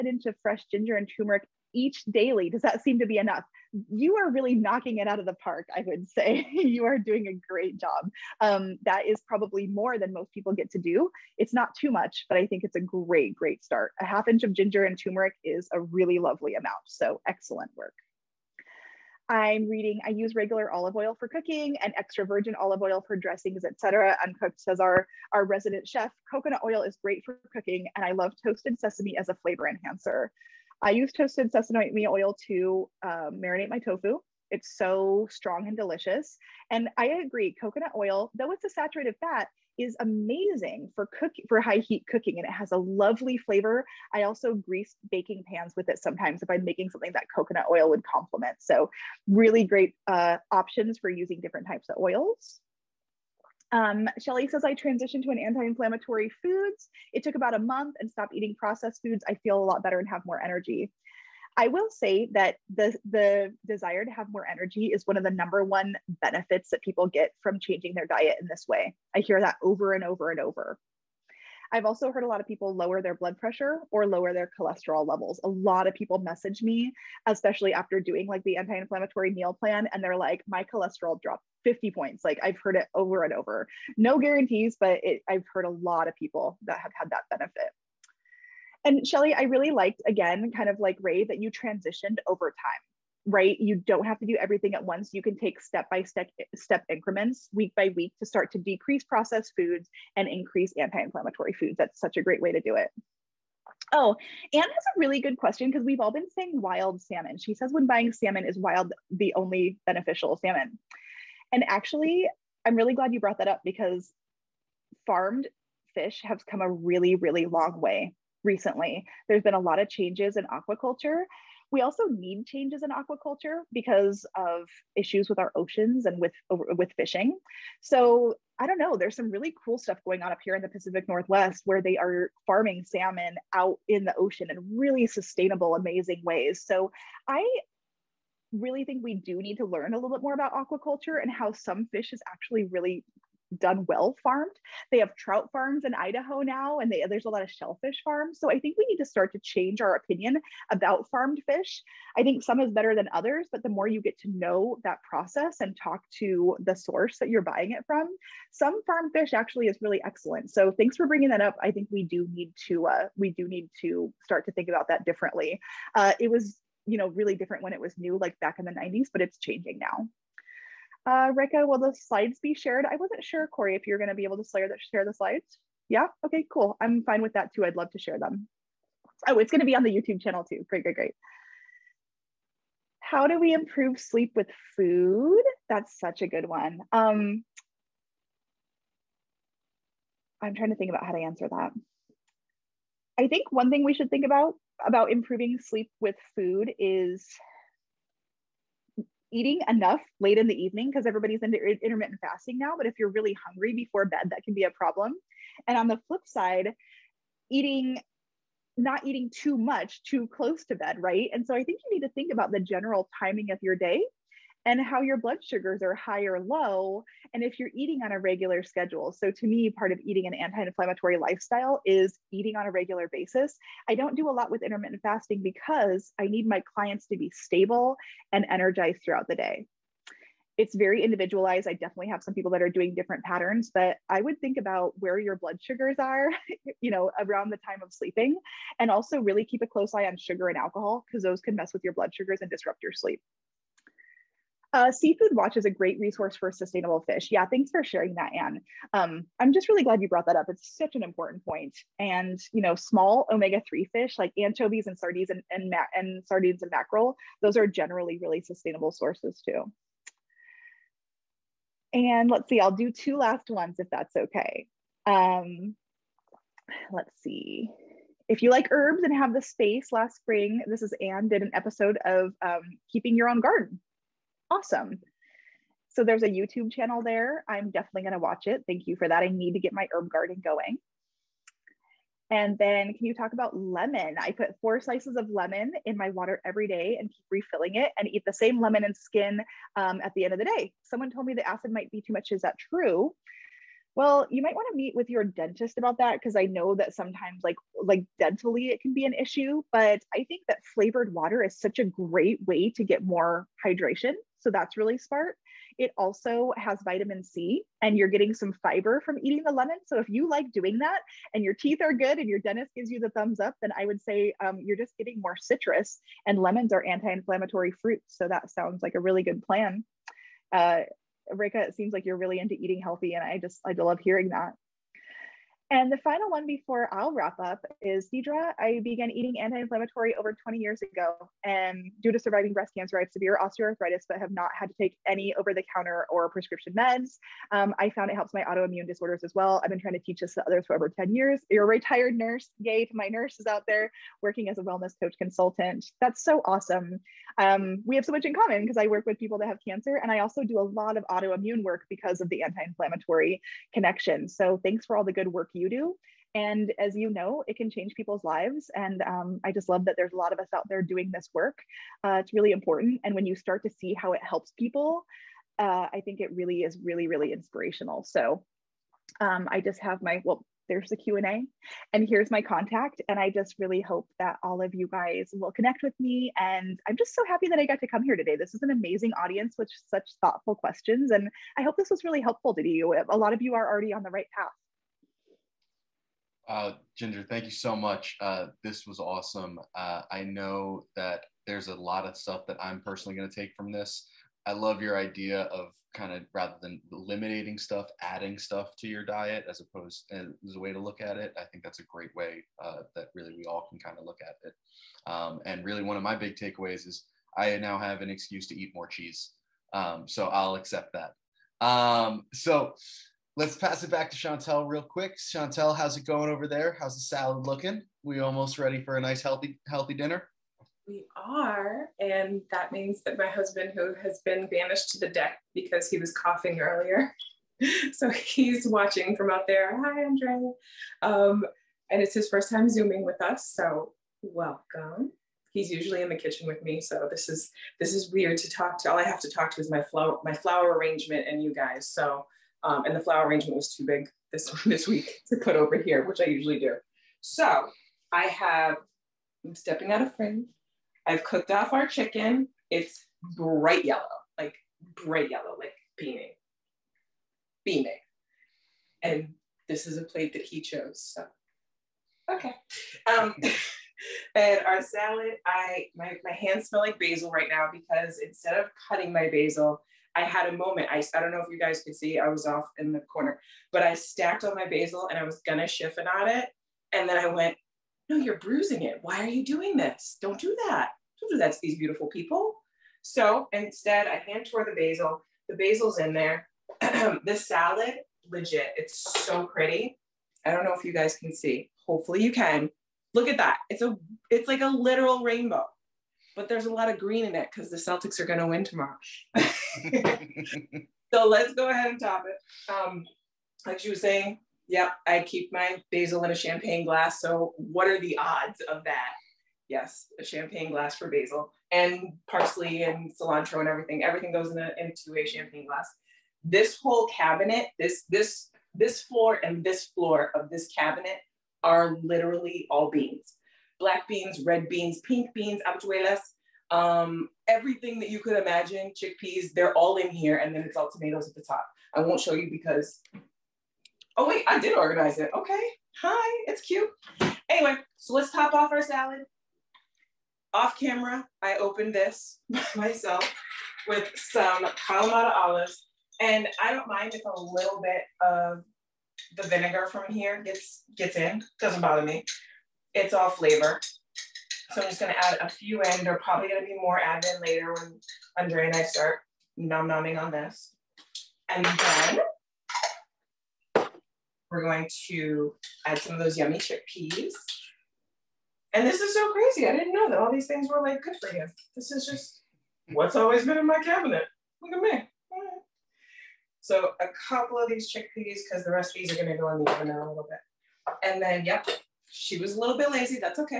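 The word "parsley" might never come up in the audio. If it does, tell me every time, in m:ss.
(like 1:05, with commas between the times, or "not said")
8:32.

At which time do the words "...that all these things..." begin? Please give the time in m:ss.
9:30.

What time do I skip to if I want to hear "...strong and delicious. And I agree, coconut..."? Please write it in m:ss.
0:35.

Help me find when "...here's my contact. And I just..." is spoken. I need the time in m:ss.
6:12.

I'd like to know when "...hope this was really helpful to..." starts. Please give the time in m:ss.
6:21.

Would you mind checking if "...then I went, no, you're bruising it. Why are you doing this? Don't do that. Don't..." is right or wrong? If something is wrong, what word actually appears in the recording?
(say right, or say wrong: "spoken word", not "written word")
right.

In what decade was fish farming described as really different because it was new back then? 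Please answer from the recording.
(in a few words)
The 90s.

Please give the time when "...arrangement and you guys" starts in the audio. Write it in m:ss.
7:20.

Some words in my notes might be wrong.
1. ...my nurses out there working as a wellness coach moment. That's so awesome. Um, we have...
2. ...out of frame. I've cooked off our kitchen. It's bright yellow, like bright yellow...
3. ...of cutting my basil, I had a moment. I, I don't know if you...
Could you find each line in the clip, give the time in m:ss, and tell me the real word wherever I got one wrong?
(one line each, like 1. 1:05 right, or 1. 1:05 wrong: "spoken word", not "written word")
1. 5:42 wrong: "consultant", not "moment"
2. 7:29 wrong: "chicken", not "kitchen"
3. 7:48 right.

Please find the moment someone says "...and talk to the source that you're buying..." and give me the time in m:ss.
2:35.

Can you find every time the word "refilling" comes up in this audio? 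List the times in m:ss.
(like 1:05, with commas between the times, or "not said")
4:47.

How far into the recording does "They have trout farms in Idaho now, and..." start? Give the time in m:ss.
2:24.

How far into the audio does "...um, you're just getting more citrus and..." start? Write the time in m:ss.
5:14.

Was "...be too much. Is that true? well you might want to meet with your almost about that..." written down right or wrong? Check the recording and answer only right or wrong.
wrong.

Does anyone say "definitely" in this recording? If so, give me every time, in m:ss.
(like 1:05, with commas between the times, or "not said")
3:51, 4:37.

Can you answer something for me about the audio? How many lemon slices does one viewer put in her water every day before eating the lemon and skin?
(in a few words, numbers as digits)
4.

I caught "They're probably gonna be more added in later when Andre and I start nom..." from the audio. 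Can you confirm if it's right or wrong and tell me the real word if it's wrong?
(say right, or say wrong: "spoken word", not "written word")
right.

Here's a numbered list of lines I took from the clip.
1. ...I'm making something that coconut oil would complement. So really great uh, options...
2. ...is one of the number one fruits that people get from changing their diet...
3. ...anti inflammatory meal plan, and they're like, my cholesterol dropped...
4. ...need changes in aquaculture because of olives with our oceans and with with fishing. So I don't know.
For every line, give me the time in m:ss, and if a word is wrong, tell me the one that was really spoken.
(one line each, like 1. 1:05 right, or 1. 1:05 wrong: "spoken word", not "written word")
1. 0:46 right
2. 1:04 wrong: "benefits", not "fruits"
3. 1:18 right
4. 2:02 wrong: "issues", not "olives".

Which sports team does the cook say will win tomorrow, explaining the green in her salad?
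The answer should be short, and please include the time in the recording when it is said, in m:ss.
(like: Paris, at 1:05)
The Celtics, at 8:17.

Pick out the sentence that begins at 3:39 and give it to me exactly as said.
So, to me, part of eating an anti inflammatory lifestyle is eating on a regular basis.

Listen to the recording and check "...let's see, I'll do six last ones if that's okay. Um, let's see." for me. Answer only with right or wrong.
wrong.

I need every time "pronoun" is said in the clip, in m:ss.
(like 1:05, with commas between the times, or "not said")
not said.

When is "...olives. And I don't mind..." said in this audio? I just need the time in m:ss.
9:05.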